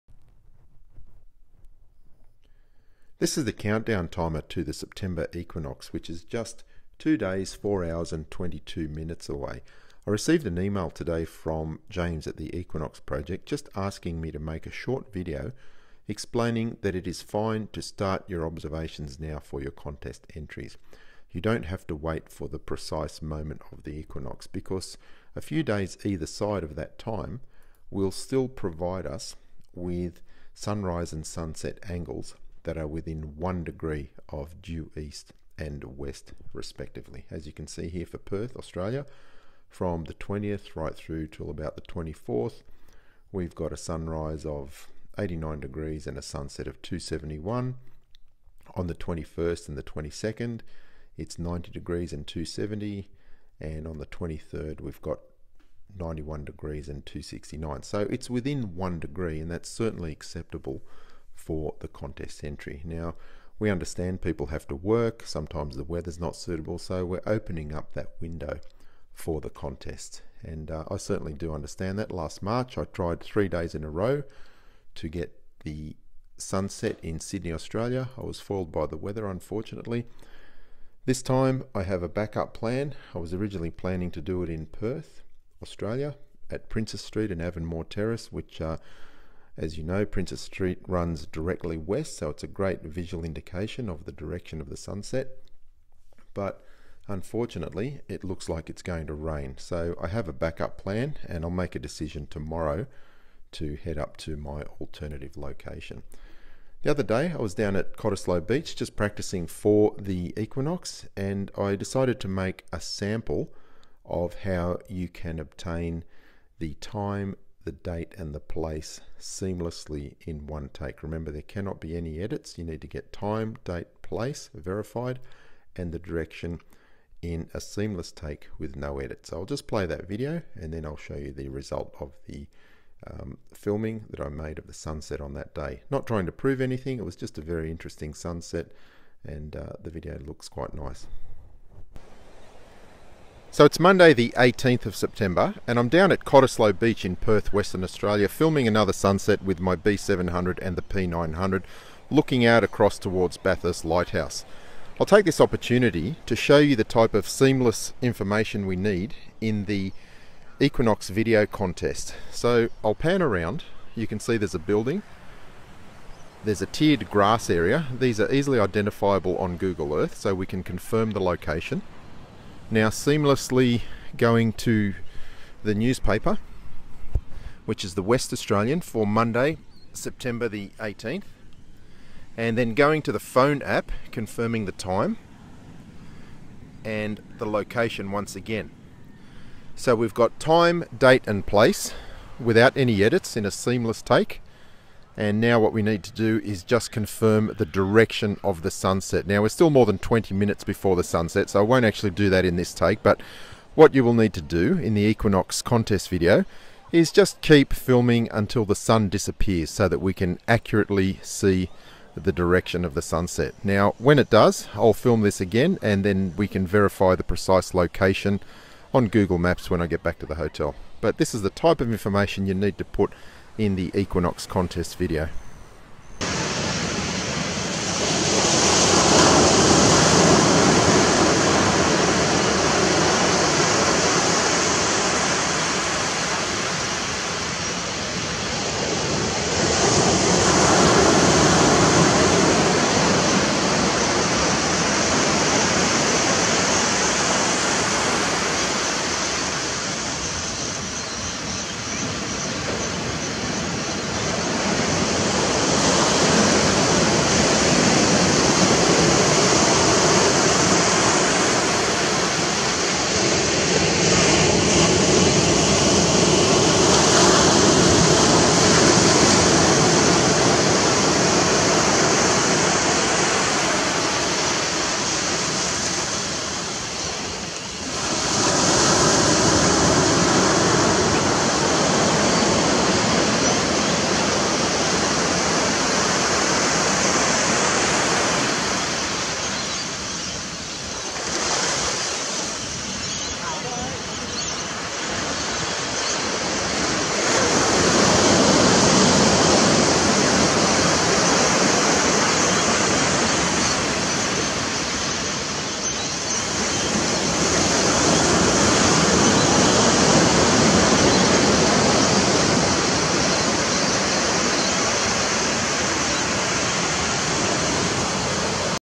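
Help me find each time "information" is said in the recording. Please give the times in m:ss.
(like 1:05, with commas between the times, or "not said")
2:38, 3:41.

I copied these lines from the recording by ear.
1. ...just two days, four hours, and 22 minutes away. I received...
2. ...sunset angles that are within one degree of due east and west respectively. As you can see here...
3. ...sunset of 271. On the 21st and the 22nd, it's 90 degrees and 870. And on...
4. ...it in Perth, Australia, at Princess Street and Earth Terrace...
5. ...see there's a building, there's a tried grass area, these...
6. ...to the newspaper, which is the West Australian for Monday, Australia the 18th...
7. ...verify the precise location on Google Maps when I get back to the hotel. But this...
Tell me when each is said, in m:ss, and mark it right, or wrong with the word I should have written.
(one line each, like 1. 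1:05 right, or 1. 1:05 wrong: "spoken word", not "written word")
1. 0:06 right
2. 0:31 right
3. 0:46 wrong: "270", not "870"
4. 1:24 wrong: "Avonmore", not "Earth"
5. 2:44 wrong: "tiered", not "tried"
6. 2:54 wrong: "September", not "Australia"
7. 3:36 right.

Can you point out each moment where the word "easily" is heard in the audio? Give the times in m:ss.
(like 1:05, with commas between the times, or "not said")
2:48.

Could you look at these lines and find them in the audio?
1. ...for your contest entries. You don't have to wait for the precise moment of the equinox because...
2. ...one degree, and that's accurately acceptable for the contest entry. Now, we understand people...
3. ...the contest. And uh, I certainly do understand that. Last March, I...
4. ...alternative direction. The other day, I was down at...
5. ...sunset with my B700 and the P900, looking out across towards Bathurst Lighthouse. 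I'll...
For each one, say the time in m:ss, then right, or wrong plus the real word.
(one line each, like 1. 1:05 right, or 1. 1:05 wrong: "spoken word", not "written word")
1. 0:19 right
2. 0:58 wrong: "certainly", not "accurately"
3. 1:09 right
4. 1:44 wrong: "location", not "direction"
5. 2:28 right.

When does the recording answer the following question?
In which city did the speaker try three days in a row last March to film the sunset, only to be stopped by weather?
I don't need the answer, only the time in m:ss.
1:17.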